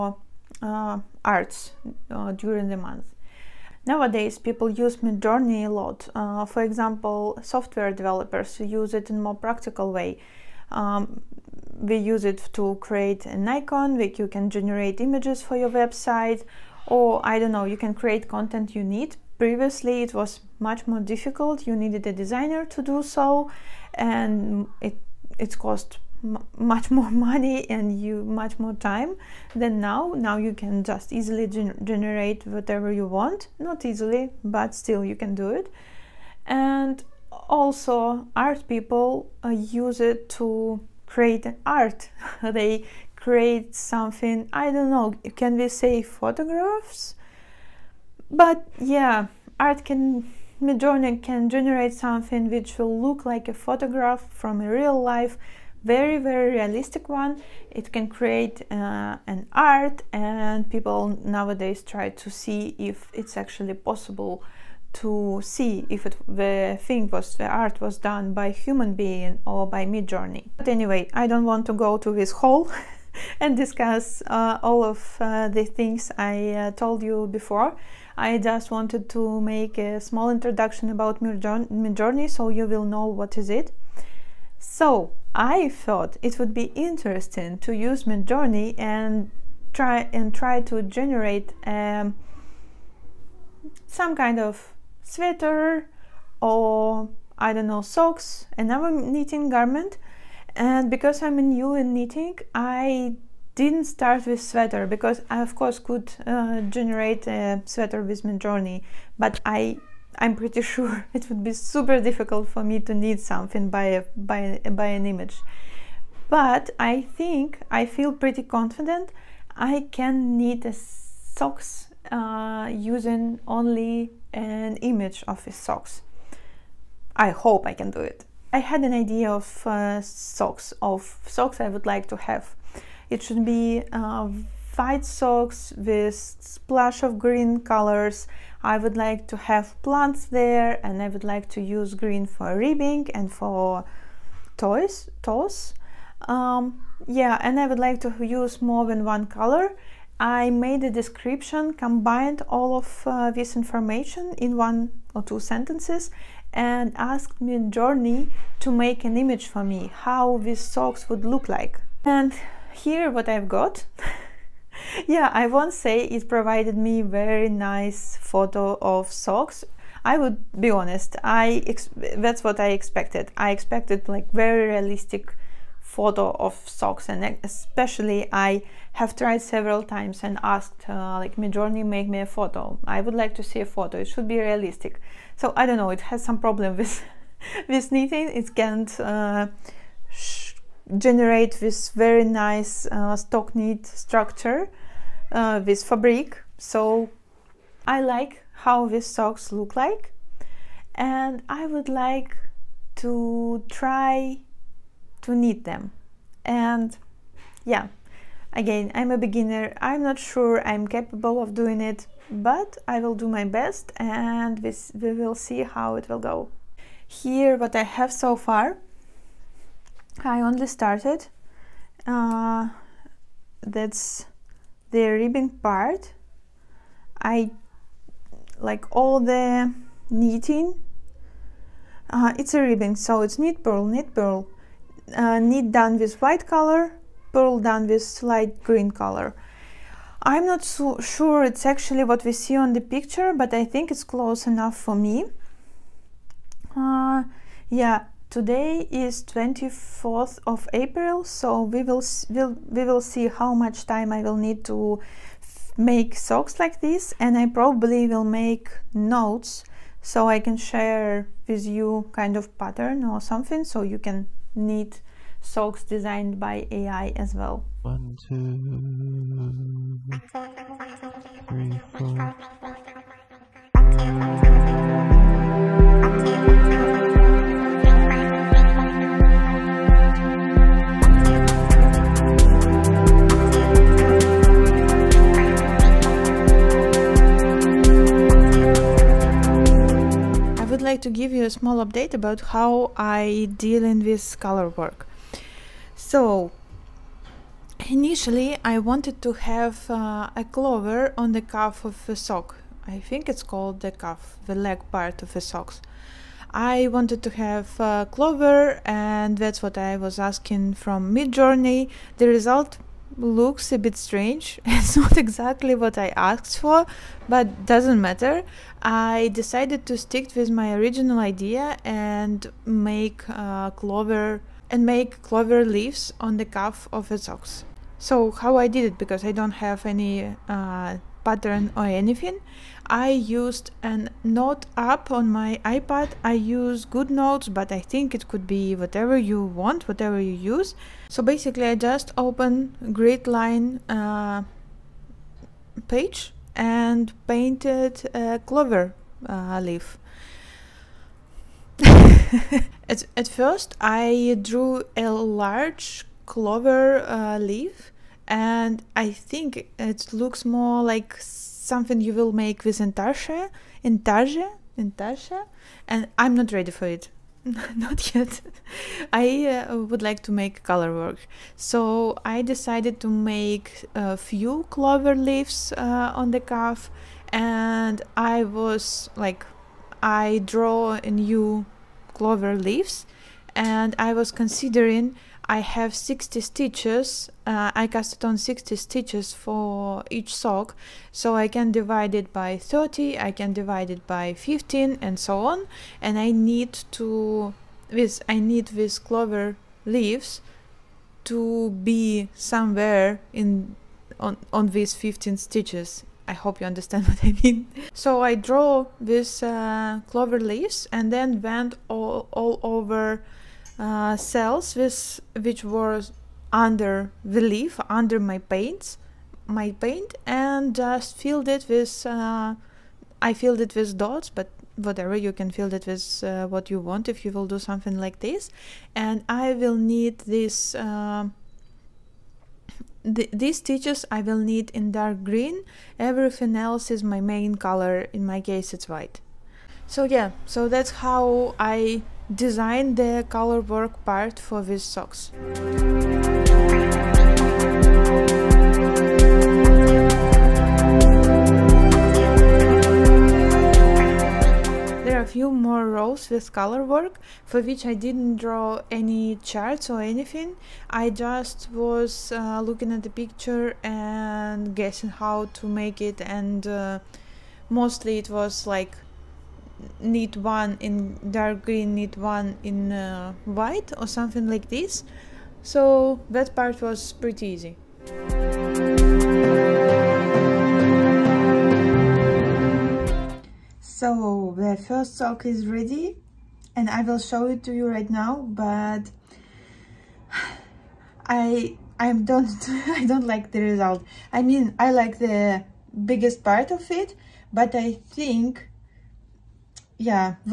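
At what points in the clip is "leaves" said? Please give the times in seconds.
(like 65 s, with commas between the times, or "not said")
325 s, 375 s, 382 s, 399 s, 410 s.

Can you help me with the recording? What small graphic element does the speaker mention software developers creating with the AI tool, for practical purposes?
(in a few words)
An icon.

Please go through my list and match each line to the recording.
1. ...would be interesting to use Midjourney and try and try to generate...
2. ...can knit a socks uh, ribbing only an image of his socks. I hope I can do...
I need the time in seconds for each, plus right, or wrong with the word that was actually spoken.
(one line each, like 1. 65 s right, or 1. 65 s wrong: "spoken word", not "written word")
1. 86 s right
2. 119 s wrong: "using", not "ribbing".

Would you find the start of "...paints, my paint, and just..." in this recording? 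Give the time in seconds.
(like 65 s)
418 s.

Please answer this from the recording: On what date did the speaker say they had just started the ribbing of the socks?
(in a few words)
24th of April.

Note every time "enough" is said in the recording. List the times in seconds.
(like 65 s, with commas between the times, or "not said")
244 s.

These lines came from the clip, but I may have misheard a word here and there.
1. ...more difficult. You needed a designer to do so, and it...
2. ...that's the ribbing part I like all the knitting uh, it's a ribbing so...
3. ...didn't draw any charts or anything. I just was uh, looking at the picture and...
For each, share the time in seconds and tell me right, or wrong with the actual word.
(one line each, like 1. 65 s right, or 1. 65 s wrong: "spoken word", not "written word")
1. 20 s right
2. 223 s right
3. 457 s right.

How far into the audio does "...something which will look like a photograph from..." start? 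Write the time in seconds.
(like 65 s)
51 s.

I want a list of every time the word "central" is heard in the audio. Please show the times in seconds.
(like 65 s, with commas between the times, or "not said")
not said.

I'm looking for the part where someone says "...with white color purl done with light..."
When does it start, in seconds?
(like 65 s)
235 s.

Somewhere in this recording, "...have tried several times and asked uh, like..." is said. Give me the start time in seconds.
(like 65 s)
178 s.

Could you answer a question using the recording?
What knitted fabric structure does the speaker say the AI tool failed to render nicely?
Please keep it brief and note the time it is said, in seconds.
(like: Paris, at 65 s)
Stockinette, at 193 s.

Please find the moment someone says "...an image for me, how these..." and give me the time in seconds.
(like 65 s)
159 s.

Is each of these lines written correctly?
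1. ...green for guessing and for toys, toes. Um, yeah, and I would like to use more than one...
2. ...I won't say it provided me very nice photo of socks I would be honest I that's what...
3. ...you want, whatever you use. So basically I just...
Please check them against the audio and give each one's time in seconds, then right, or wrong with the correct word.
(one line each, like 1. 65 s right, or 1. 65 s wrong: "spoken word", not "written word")
1. 141 s wrong: "ribbing", not "guessing"
2. 165 s right
3. 339 s right.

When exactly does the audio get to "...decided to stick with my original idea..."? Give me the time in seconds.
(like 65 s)
319 s.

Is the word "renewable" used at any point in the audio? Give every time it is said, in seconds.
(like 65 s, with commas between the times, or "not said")
not said.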